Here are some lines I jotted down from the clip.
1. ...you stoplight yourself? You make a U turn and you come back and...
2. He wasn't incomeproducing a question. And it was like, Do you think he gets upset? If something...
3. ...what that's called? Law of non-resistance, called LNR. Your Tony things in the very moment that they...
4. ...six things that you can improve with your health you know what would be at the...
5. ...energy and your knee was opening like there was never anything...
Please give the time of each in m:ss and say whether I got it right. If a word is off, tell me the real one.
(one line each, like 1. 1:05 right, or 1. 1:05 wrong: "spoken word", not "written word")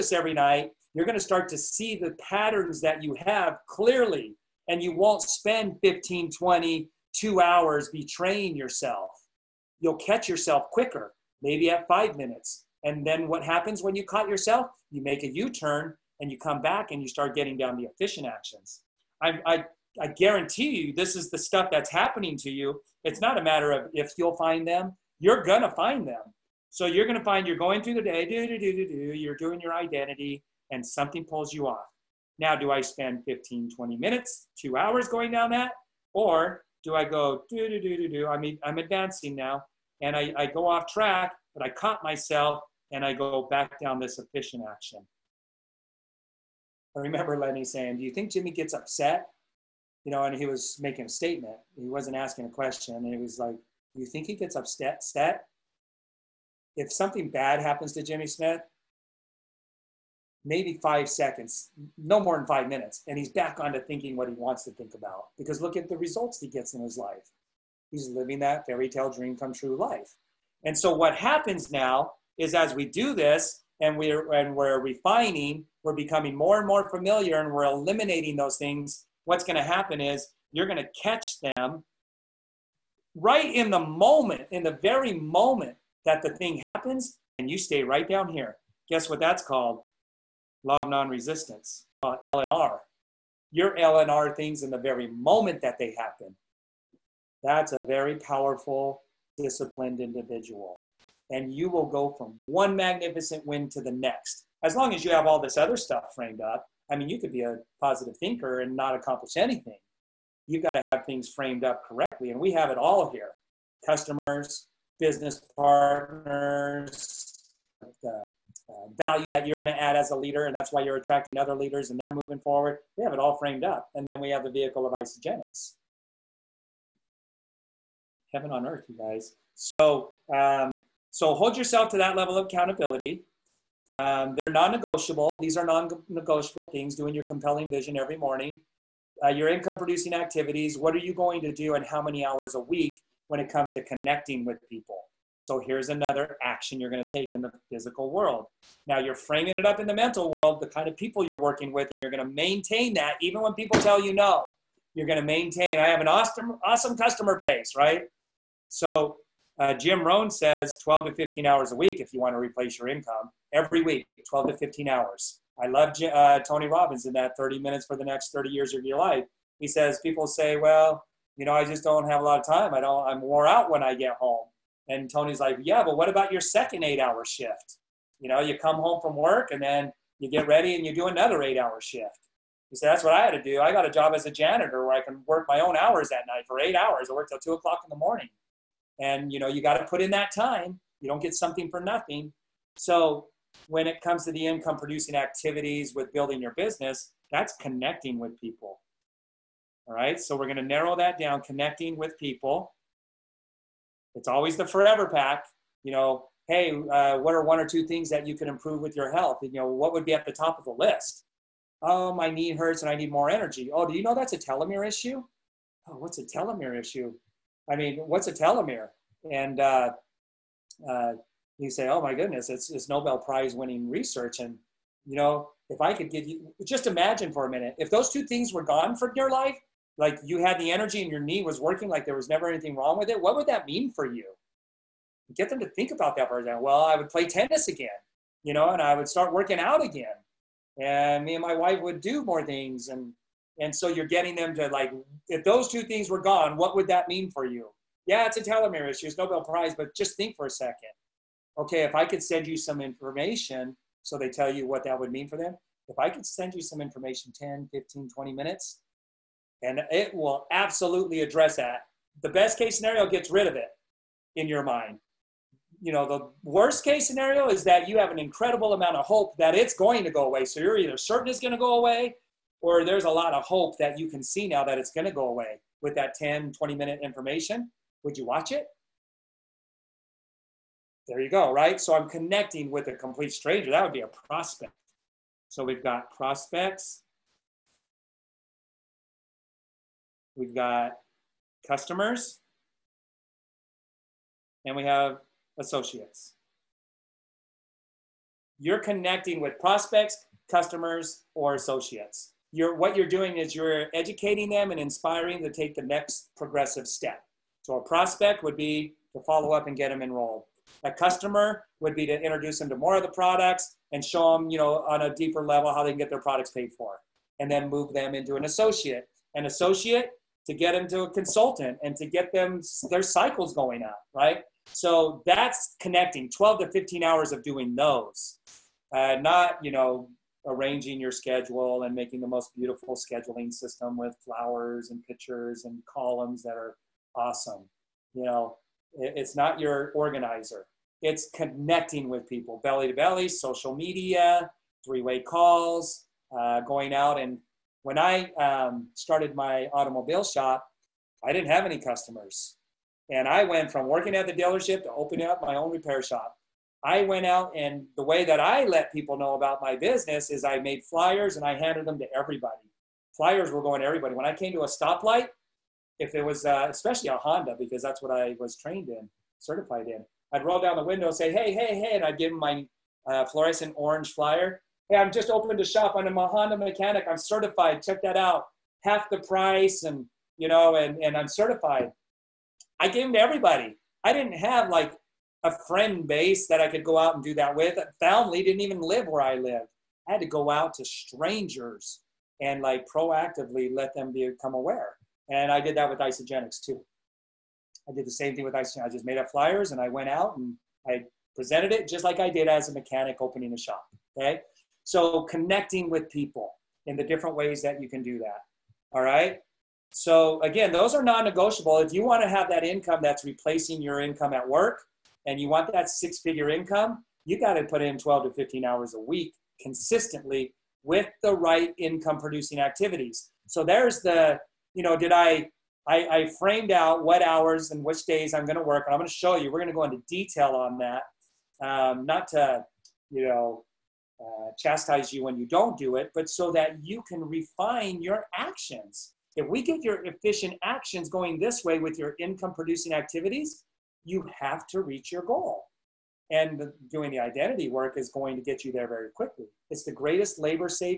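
1. 0:13 wrong: "caught", not "stoplight"
2. 0:51 wrong: "asking", not "incomeproducing"
3. 1:29 wrong: "LNR", not "Tony"
4. 3:27 wrong: "two", not "six"
5. 3:50 wrong: "working", not "opening".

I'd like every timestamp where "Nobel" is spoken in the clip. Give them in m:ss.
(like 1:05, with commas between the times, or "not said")
3:42, 4:09.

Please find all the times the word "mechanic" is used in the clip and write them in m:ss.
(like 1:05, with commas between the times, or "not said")
6:16, 6:42.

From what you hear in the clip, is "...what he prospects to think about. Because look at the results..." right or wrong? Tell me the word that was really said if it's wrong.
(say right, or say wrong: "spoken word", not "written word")
wrong: "wants", not "prospects".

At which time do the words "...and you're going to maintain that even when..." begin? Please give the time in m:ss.
2:31.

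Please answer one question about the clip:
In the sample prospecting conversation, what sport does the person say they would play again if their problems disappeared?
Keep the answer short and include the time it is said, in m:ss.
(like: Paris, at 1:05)
Tennis, at 3:57.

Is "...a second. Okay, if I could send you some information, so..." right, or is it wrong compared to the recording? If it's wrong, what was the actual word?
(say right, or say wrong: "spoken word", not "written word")
right.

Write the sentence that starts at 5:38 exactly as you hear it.
You know, it's not your organizer.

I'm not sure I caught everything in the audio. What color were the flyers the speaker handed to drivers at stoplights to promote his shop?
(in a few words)
Fluorescent orange.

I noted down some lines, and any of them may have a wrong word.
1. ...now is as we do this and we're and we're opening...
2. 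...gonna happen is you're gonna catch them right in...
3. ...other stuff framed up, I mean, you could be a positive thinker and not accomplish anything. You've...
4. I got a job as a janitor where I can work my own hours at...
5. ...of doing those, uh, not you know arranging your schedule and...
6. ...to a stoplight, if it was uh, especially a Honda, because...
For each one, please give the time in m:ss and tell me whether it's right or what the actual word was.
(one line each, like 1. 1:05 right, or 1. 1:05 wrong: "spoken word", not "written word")
1. 1:11 wrong: "refining", not "opening"
2. 1:19 right
3. 1:45 right
4. 3:03 right
5. 5:27 right
6. 6:04 right.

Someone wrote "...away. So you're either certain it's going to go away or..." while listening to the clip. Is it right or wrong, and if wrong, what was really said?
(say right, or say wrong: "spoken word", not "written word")
right.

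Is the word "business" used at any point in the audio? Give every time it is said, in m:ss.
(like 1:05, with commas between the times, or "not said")
1:54, 3:16, 5:59.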